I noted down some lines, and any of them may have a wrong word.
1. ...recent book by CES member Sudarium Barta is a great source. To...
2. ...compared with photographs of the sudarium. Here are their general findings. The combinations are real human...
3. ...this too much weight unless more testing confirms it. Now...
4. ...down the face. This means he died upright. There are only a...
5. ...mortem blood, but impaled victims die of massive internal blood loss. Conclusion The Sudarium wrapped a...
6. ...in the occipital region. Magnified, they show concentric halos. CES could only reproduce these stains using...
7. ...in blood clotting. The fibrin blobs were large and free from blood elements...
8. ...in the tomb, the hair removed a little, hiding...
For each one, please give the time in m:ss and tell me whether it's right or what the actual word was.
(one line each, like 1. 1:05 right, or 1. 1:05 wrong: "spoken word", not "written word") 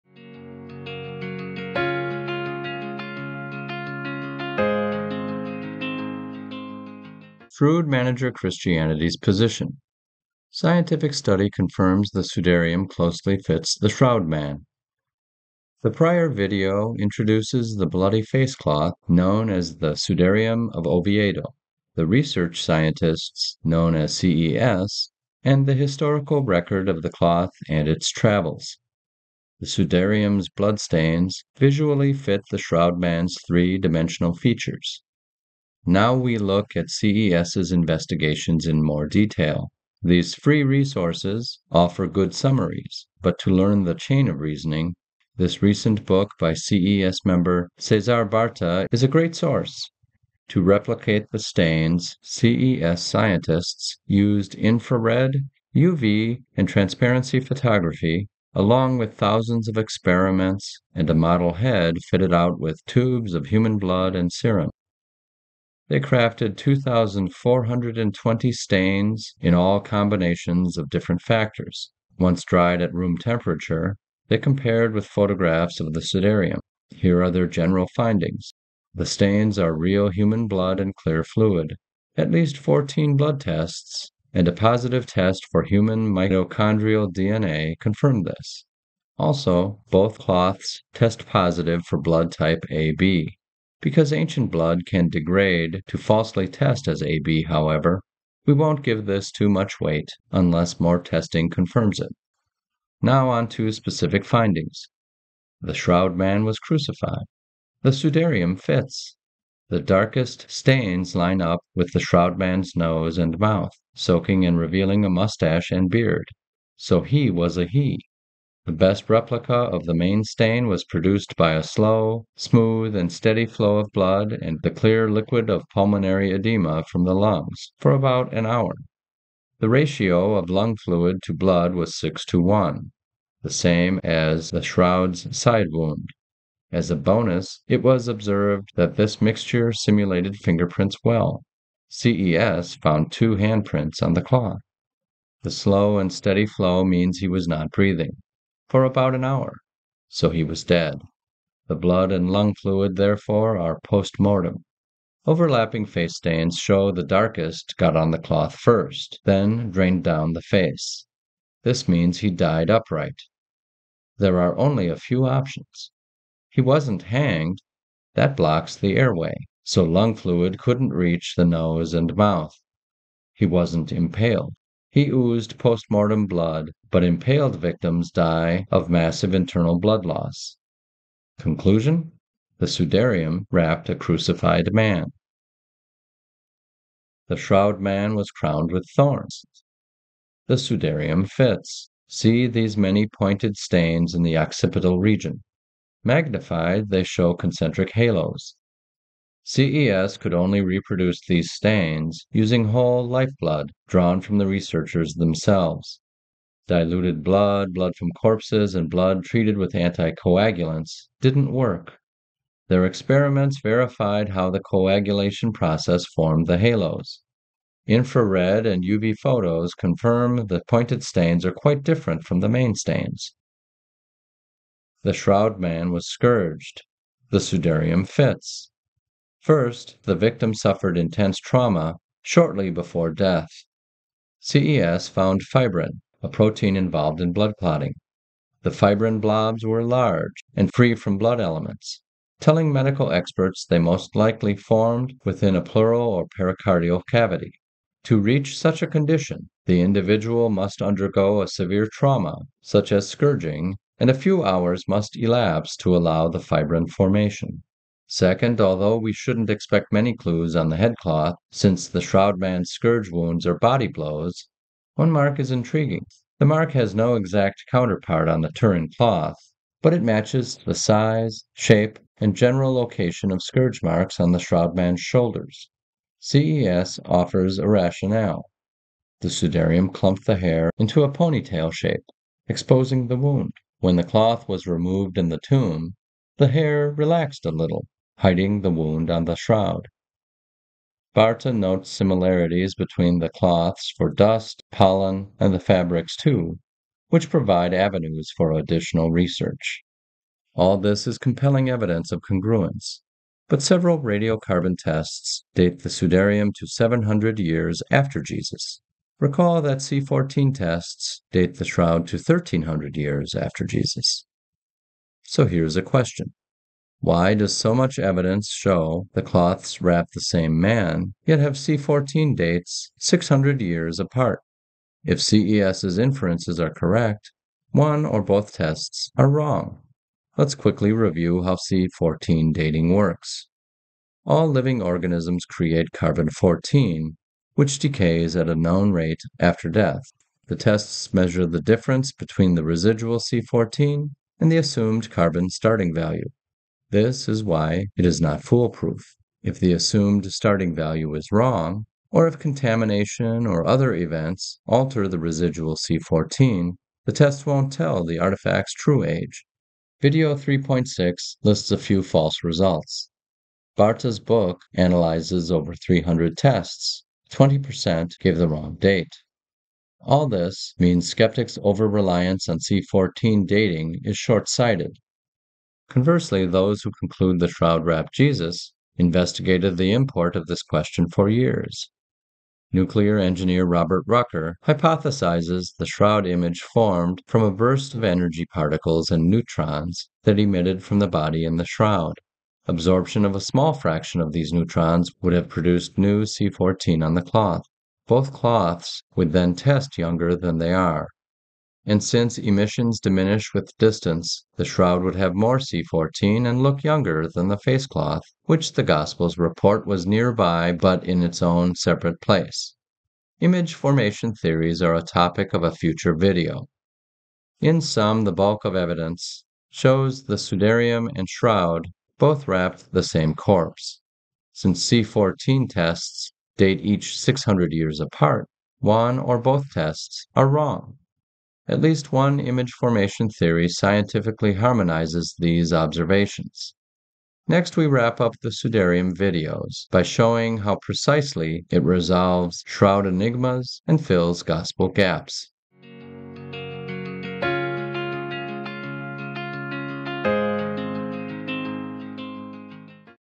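1. 0:45 wrong: "Cesar", not "Sudarium"
2. 1:14 wrong: "stains", not "combinations"
3. 1:39 right
4. 2:40 right
5. 2:55 right
6. 3:14 right
7. 3:57 right
8. 4:45 wrong: "relaxed", not "removed".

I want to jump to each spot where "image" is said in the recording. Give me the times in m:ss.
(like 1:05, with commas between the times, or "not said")
6:26, 6:53, 7:12.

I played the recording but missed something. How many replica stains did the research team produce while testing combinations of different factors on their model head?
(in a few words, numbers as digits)
2,420.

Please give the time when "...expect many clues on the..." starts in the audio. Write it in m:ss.
4:19.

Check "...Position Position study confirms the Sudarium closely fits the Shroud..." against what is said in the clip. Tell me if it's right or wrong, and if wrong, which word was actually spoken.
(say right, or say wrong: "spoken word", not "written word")
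wrong: "Scientific", not "Position".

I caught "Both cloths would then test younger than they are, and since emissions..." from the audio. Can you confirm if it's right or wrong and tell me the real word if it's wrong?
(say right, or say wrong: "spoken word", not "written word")
right.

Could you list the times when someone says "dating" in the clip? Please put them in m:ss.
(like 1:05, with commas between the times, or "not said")
5:32, 6:13.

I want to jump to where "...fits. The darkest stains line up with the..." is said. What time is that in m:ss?
1:48.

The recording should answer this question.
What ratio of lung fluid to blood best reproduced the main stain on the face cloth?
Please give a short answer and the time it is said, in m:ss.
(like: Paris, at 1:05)
6 to 1, at 2:11.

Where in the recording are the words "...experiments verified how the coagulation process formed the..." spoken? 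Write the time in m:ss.
3:32.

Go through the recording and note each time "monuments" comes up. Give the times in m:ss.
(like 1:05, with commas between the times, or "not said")
not said.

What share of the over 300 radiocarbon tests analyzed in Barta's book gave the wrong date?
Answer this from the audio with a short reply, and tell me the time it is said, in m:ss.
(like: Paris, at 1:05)
20%, at 6:07.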